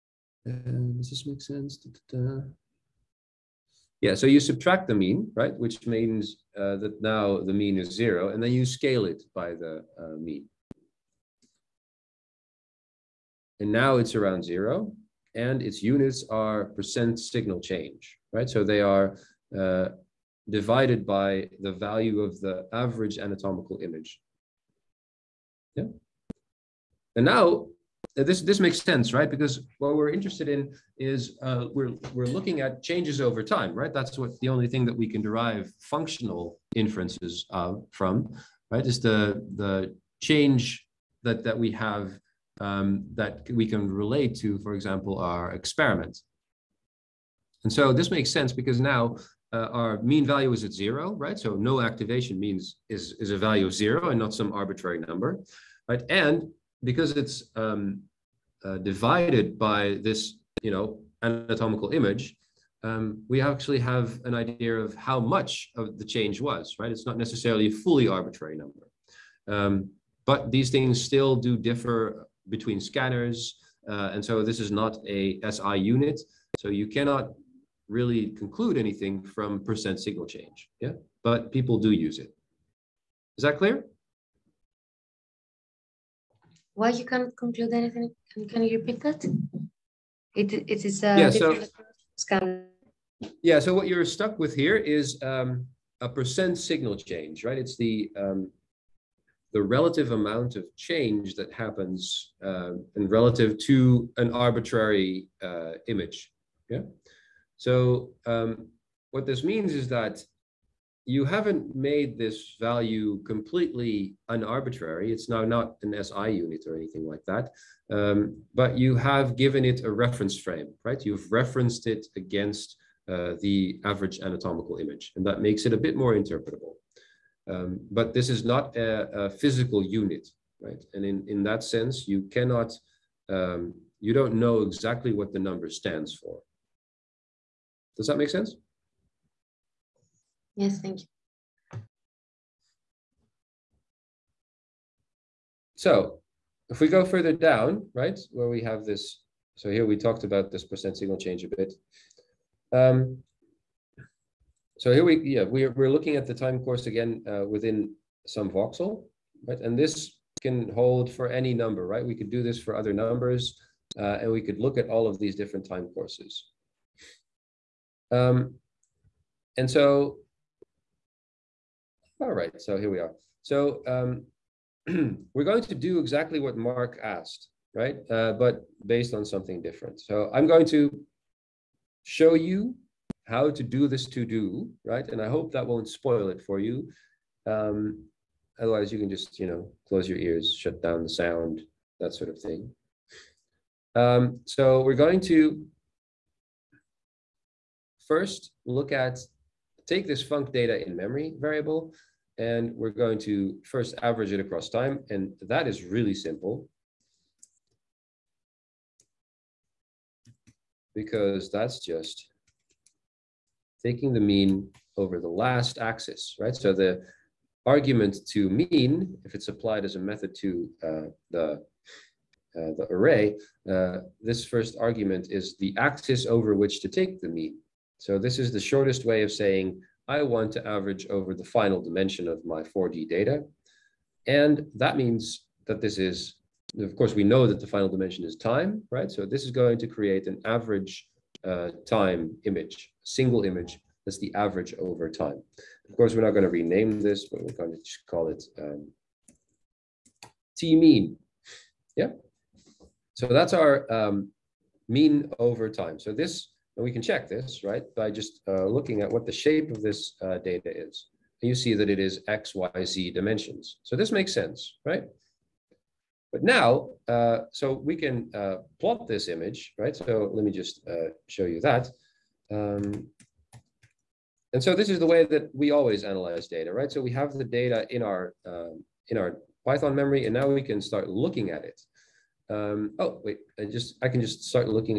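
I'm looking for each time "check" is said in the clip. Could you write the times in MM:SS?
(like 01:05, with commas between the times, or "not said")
04:17.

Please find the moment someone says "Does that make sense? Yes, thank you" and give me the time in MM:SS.
02:17.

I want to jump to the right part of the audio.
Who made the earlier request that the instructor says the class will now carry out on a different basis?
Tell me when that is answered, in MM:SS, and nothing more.
02:56.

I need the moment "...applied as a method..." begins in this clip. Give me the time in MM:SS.
03:39.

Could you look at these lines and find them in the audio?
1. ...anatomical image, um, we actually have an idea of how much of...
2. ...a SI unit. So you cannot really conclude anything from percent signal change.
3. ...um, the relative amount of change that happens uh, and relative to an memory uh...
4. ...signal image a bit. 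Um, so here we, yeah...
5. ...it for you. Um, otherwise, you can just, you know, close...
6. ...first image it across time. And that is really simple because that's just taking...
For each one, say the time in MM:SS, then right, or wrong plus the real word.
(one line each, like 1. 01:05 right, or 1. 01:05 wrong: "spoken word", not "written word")
1. 01:01 right
2. 01:15 right
3. 01:38 wrong: "arbitrary", not "memory"
4. 02:30 wrong: "change", not "image"
5. 03:06 right
6. 03:23 wrong: "average", not "image".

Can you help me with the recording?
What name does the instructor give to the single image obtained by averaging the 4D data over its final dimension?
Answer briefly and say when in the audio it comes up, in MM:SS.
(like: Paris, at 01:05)
t-mean, at 04:10.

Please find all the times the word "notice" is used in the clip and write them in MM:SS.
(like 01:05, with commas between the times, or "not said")
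not said.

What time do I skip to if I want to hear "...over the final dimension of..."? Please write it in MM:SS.
03:51.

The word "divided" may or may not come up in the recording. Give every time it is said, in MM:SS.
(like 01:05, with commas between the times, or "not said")
00:20, 00:58.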